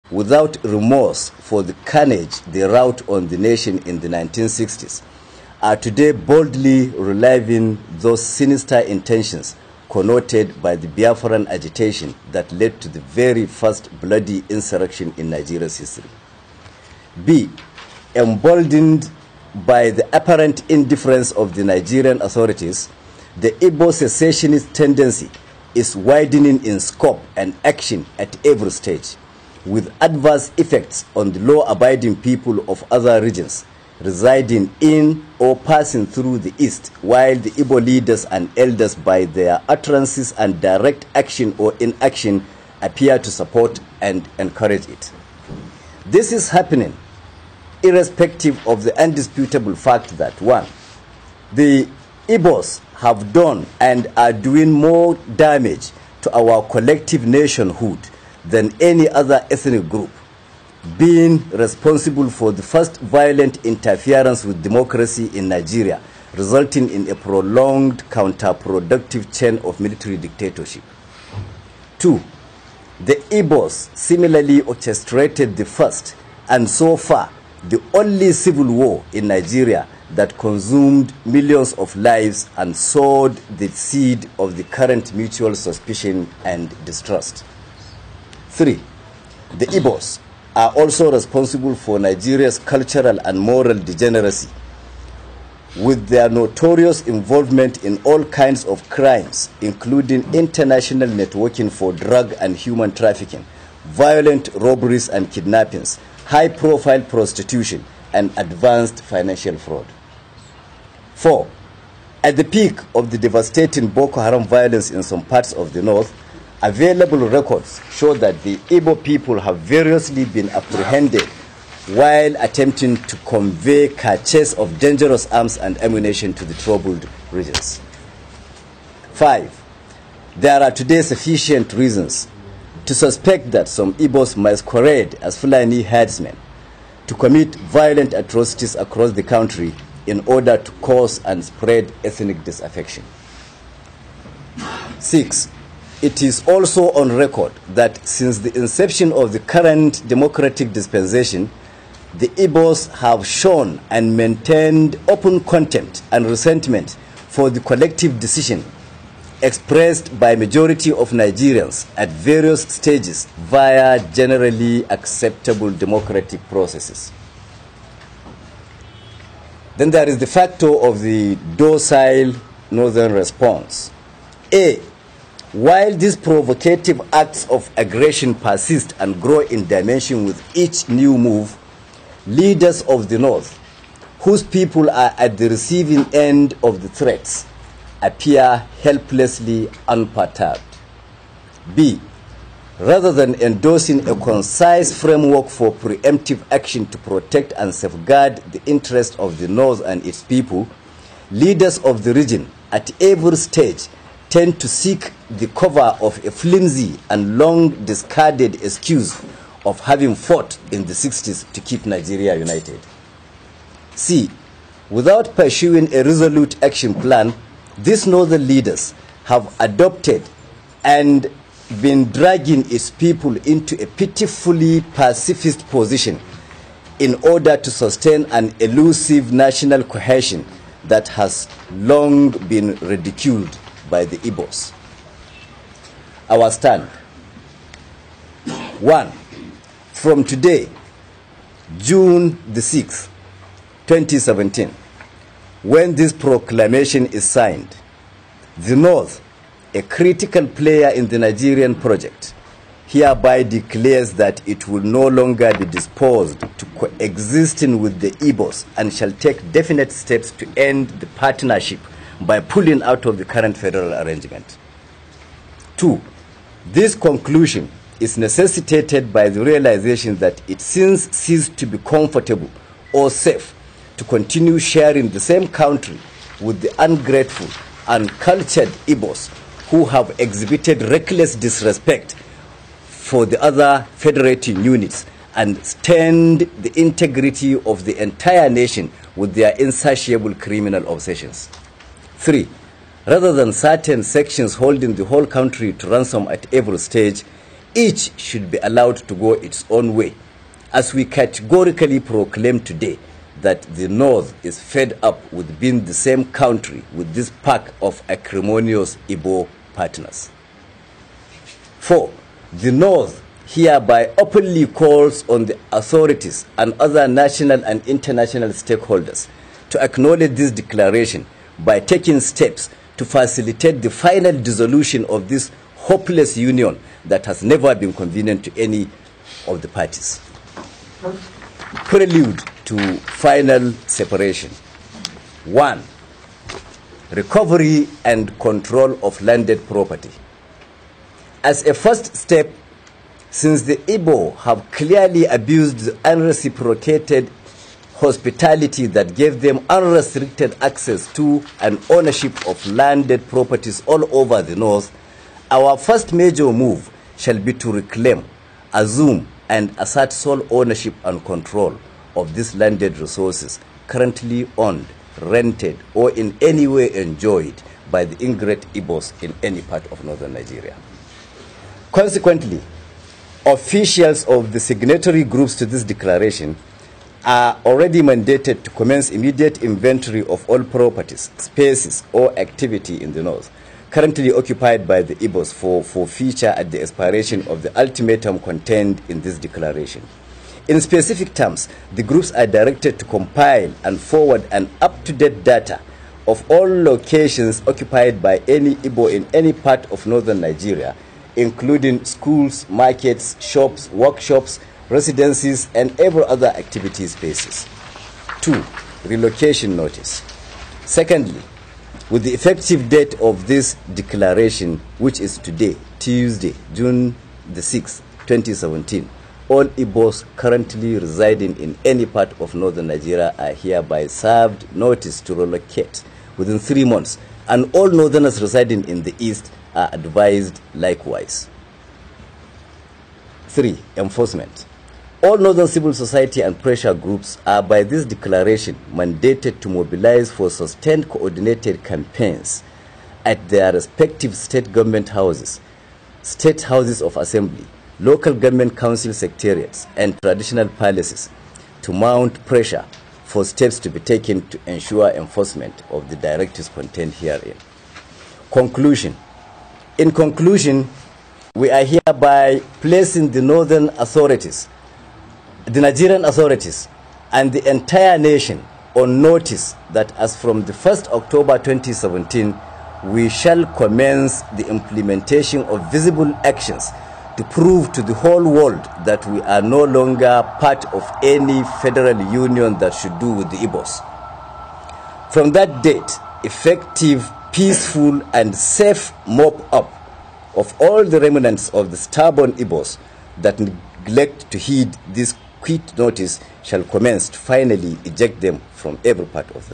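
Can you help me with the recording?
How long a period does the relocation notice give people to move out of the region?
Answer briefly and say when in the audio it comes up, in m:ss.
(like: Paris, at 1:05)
3 months, at 7:06.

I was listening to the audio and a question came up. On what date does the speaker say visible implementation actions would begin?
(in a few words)
1 October 2017.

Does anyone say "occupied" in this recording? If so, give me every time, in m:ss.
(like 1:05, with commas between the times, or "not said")
6:24, 6:37.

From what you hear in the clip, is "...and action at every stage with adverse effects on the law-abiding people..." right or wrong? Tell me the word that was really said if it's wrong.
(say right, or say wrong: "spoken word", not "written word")
right.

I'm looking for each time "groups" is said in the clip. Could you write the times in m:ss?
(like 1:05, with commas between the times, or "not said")
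0:59, 6:15, 6:32, 7:16.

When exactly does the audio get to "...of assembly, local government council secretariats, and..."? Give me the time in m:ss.
7:27.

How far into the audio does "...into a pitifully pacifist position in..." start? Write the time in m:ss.
3:43.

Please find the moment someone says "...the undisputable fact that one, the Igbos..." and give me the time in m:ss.
0:48.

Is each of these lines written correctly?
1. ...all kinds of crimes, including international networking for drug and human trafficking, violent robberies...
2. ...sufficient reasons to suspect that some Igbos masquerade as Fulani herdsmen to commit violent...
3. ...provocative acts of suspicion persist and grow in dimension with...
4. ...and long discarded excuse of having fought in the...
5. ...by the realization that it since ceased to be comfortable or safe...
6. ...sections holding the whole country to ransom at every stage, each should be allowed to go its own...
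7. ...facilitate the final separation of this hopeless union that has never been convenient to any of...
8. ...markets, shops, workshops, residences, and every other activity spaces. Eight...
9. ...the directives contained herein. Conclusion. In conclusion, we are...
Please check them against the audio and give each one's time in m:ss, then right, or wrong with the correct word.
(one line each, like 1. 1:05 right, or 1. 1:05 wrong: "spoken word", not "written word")
1. 1:38 right
2. 2:11 right
3. 2:56 wrong: "aggression", not "suspicion"
4. 3:27 right
5. 4:29 right
6. 4:54 right
7. 5:23 wrong: "dissolution", not "separation"
8. 6:42 wrong: "Two", not "Eight"
9. 7:36 right.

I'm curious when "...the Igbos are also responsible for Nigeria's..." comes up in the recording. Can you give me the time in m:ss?
1:29.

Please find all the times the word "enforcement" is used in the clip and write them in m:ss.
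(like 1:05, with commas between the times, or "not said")
7:13, 7:35.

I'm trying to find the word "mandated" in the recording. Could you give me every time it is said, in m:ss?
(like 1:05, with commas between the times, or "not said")
6:18, 7:18.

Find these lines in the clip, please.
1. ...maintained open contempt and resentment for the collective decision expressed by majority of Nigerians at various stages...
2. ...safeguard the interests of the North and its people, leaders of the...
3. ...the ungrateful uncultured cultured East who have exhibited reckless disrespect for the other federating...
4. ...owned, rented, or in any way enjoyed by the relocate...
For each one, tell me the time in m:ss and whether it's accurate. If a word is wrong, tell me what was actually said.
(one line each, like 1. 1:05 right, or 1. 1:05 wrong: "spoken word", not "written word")
1. 2:34 right
2. 3:17 right
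3. 4:36 wrong: "Igbos", not "East"
4. 6:04 wrong: "ingrate", not "relocate".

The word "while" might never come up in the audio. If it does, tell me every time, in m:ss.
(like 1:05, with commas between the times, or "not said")
0:37, 2:01, 2:55.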